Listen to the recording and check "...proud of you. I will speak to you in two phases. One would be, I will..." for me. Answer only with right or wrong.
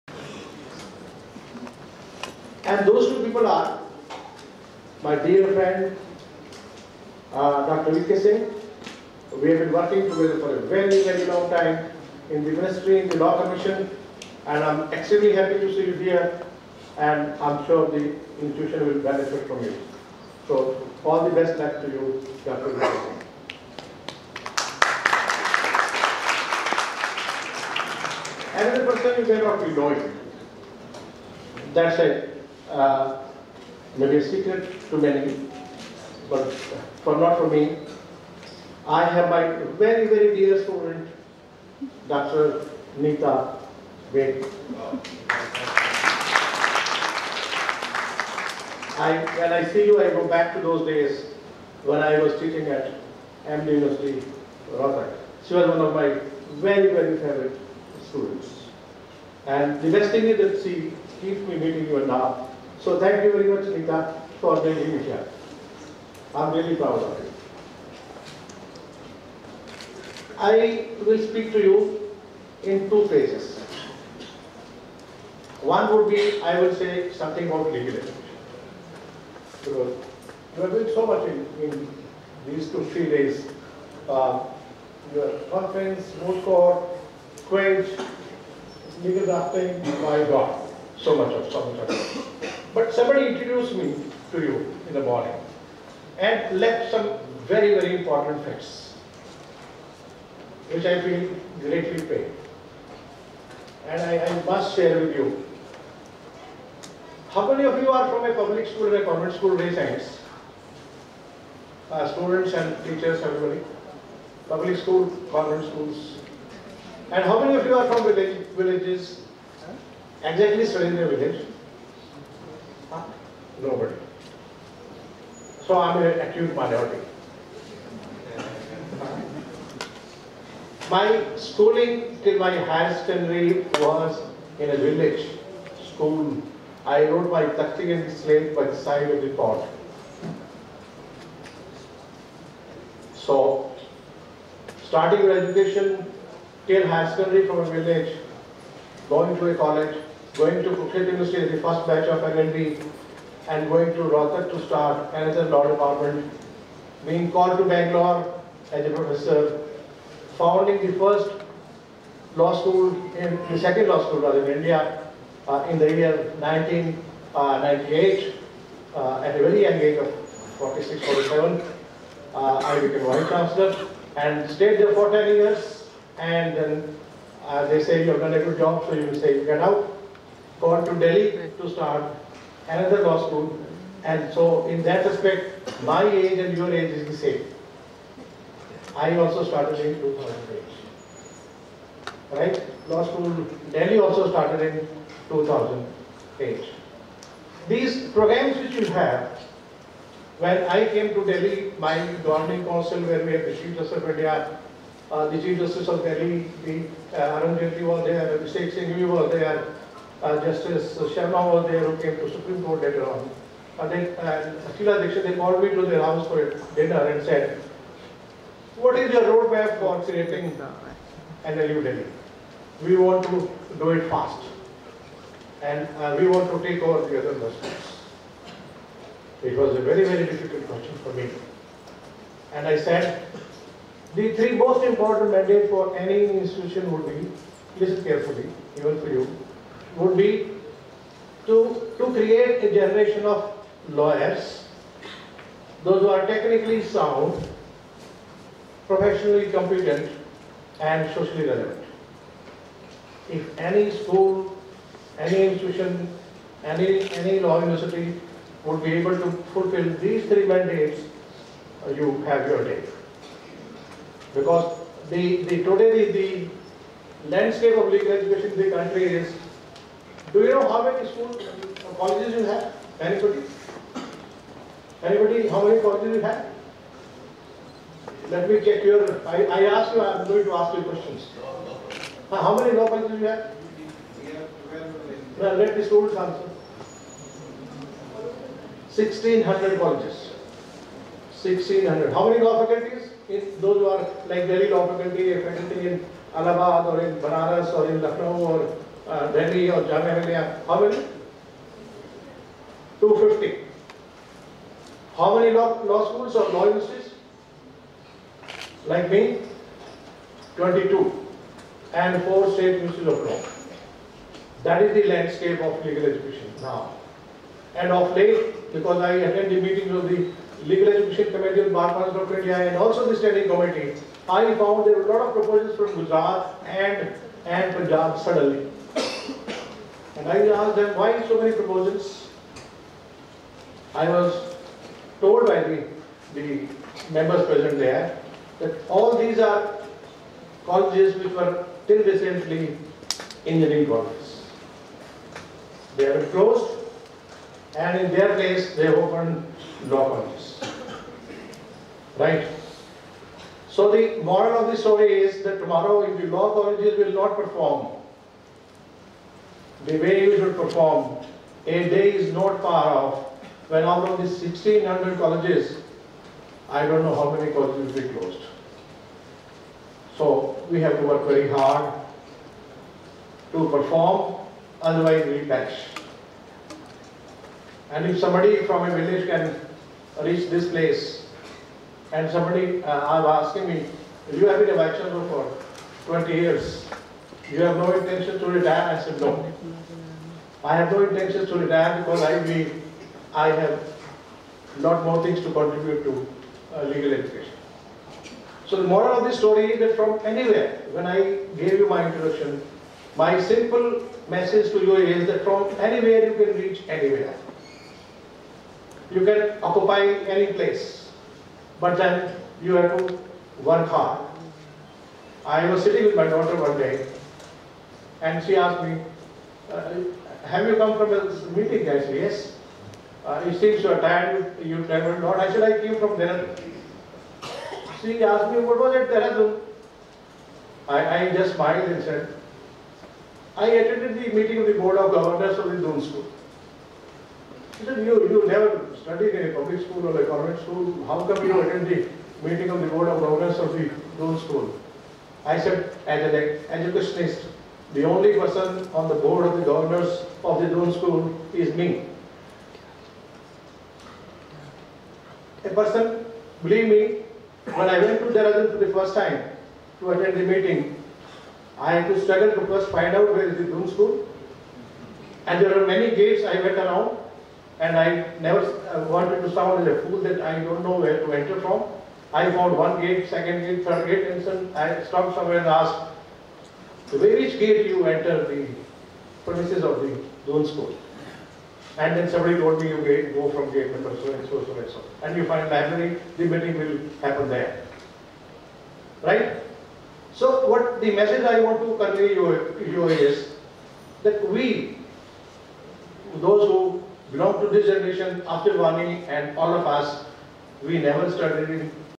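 right.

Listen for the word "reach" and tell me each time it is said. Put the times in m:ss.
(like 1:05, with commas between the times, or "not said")
6:20, 6:46.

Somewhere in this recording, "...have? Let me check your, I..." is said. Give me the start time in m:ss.
4:36.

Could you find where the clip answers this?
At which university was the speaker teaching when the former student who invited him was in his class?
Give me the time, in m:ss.
0:53.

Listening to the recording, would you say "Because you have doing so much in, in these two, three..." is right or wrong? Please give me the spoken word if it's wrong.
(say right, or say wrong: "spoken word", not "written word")
right.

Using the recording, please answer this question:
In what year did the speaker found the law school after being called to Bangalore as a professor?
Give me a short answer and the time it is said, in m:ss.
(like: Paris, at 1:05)
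1998, at 2:46.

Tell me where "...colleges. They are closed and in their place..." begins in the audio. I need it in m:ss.
5:43.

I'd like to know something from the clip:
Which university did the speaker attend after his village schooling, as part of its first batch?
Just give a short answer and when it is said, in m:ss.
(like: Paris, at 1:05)
Kurukshetra University, at 2:30.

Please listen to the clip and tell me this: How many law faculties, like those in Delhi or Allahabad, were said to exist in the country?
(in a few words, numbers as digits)
250.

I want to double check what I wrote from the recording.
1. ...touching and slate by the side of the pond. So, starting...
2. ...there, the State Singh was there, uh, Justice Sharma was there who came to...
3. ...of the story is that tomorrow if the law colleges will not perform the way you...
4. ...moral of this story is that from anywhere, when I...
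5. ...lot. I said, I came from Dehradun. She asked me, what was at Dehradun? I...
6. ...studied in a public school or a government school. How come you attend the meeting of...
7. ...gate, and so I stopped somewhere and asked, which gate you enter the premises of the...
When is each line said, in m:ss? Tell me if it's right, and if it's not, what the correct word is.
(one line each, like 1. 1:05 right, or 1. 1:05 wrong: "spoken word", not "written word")
1. 2:17 right
2. 3:28 right
3. 5:54 right
4. 6:38 right
5. 7:05 right
6. 7:19 right
7. 7:54 right.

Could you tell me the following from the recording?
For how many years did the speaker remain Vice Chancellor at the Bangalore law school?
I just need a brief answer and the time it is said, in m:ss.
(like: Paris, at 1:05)
10 years, at 2:55.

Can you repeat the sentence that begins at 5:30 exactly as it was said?
And I asked them, why so many proposals?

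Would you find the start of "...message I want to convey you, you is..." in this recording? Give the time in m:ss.
8:11.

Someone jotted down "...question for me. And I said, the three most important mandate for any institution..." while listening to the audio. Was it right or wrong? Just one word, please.
right.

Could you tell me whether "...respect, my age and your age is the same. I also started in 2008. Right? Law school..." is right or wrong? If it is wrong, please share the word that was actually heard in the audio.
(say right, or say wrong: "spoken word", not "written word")
right.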